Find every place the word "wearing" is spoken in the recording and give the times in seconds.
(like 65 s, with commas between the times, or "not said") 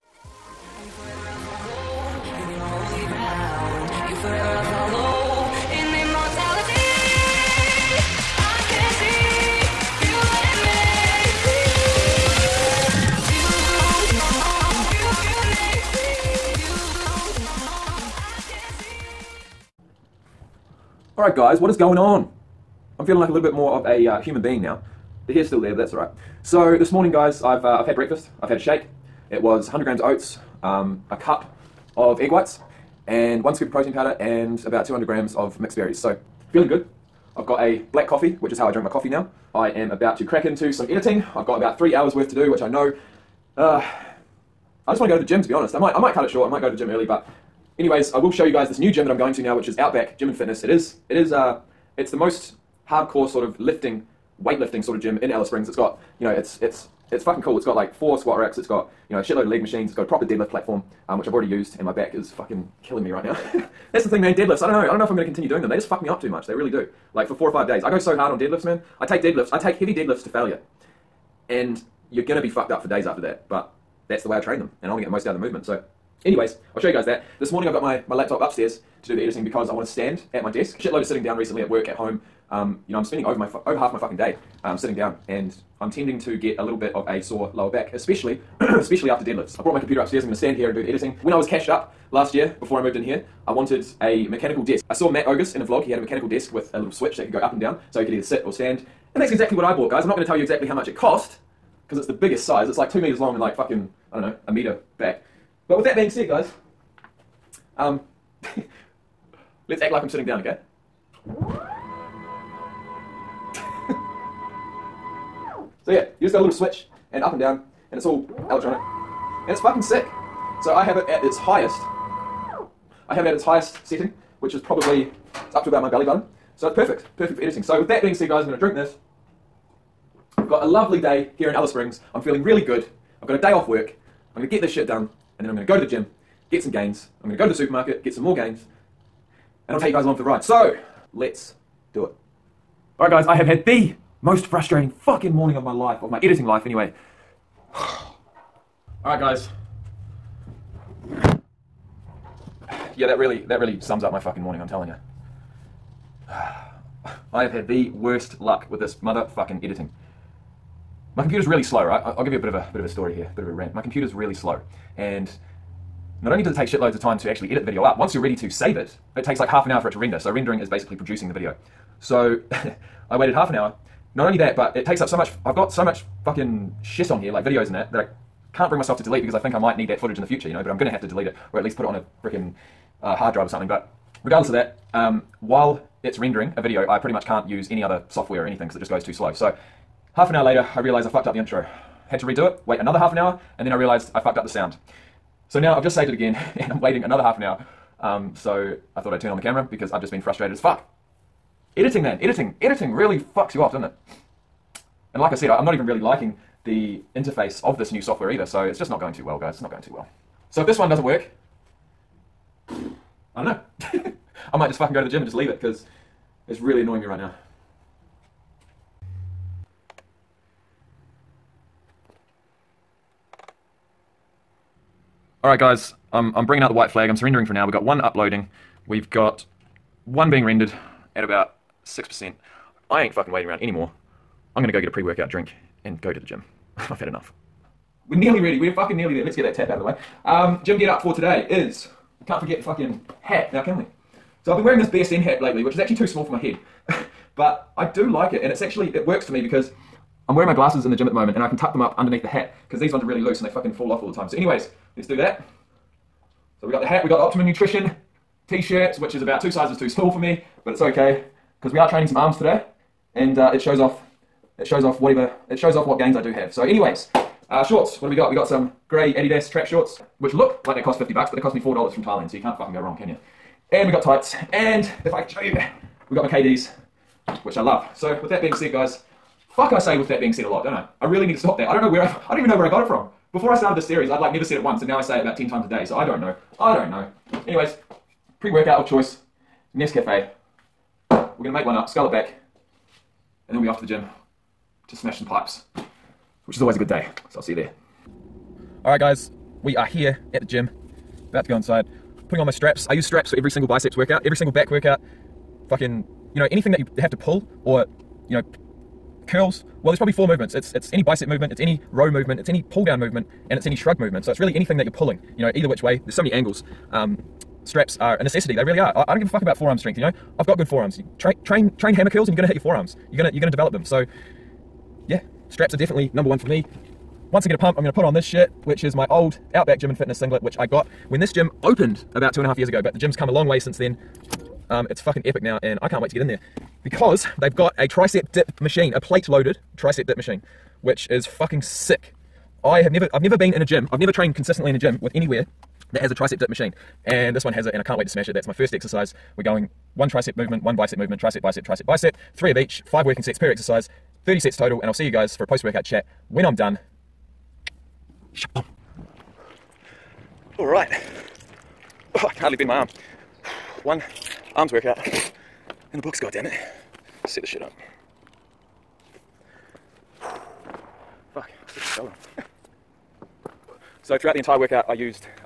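244 s, 250 s.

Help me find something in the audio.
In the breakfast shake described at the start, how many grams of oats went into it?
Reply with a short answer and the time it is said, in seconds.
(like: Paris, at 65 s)
100 grams, at 29 s.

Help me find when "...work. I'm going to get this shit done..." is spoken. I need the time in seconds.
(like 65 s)
133 s.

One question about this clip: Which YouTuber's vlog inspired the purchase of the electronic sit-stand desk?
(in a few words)
Matt Ogus.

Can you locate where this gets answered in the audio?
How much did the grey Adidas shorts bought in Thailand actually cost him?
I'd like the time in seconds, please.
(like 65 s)
271 s.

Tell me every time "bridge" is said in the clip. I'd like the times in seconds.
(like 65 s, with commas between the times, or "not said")
not said.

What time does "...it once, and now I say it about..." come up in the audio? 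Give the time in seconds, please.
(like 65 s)
284 s.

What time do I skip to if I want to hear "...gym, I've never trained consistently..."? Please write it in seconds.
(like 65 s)
343 s.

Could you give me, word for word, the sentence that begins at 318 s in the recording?
I, I, don't give a fuck about forearm strength.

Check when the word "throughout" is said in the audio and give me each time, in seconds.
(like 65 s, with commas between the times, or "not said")
374 s.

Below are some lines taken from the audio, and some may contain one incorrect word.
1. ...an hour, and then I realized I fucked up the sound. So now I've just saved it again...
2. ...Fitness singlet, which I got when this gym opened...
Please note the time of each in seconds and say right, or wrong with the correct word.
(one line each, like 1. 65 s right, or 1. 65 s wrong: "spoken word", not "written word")
1. 193 s right
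2. 329 s right.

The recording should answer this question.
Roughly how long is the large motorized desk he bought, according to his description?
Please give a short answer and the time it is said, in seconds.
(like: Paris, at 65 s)
2 meters, at 102 s.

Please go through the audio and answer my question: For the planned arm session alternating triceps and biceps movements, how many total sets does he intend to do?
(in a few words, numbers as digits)
30.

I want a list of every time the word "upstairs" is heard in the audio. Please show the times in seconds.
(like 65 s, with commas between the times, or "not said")
78 s, 89 s.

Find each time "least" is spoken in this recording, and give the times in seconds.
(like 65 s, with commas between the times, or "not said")
181 s.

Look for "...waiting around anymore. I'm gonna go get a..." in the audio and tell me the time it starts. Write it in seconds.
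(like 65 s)
233 s.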